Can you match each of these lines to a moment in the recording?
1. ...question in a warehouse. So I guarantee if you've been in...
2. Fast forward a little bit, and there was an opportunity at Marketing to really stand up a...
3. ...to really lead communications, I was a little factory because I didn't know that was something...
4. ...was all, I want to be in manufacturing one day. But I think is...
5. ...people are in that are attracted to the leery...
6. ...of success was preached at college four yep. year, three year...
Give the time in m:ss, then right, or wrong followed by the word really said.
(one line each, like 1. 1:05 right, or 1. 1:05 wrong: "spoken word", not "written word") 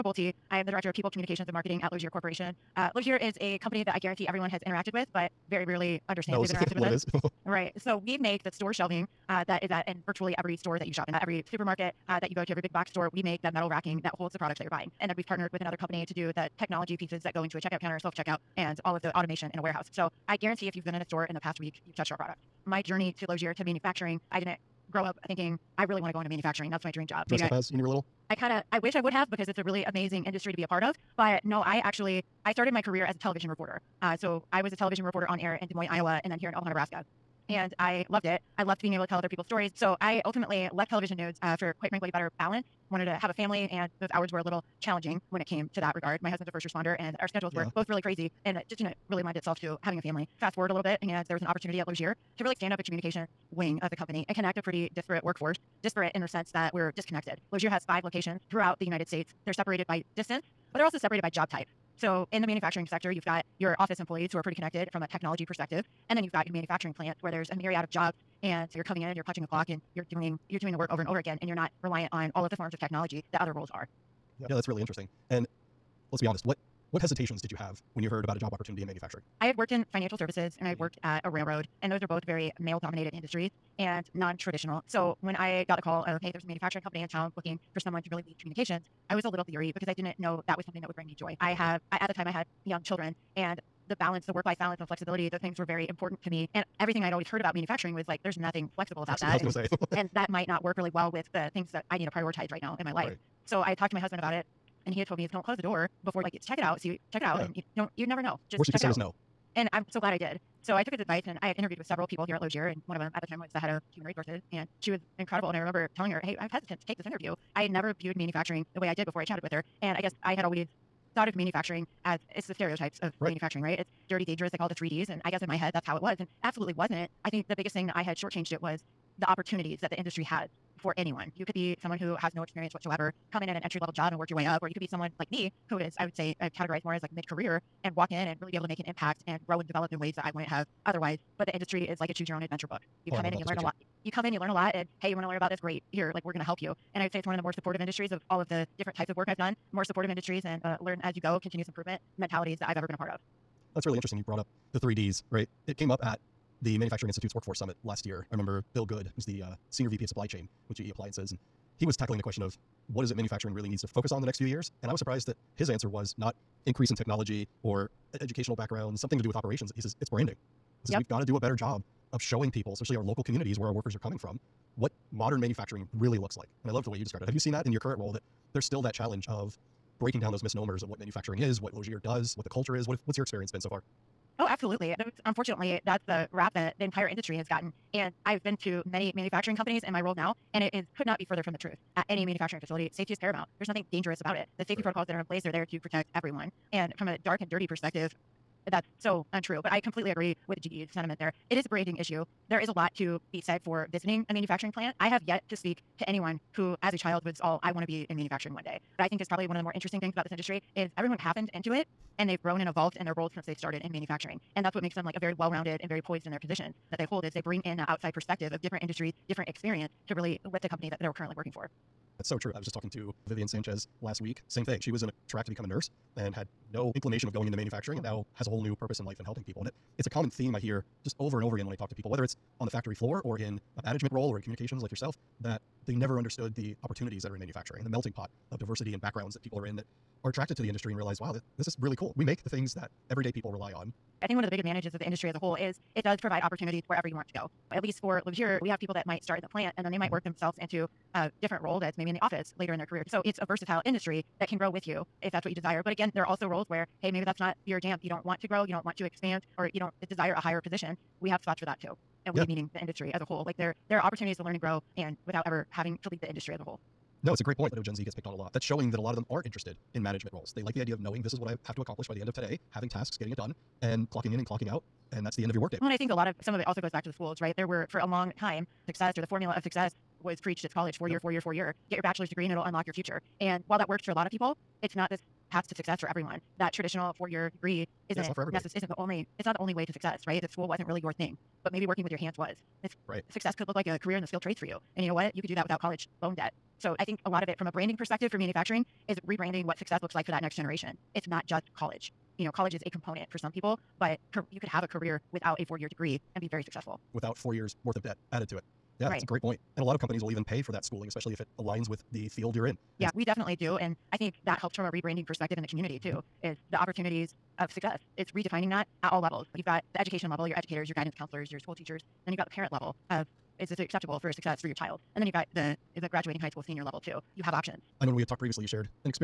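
1. 0:19 wrong: "automation", not "question"
2. 0:50 wrong: "Lozier", not "Marketing"
3. 1:28 wrong: "leery", not "factory"
4. 3:27 right
5. 3:59 wrong: "industry", not "leery"
6. 4:39 wrong: "four", not "three".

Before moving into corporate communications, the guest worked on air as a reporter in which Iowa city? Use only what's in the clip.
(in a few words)
Des Moines.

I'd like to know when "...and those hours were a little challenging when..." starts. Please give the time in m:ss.
0:43.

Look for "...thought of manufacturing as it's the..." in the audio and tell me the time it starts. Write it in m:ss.
2:01.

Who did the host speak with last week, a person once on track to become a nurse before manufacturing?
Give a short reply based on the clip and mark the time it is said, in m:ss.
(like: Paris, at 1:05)
Vivian Sanchez, at 3:43.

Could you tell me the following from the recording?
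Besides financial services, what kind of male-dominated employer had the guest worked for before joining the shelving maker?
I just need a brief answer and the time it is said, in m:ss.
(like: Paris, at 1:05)
A railroad, at 1:21.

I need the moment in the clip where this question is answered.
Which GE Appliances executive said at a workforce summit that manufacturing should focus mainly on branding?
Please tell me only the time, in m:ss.
2:38.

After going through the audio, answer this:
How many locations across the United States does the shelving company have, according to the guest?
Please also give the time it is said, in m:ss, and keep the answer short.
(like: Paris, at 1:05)
5, at 0:57.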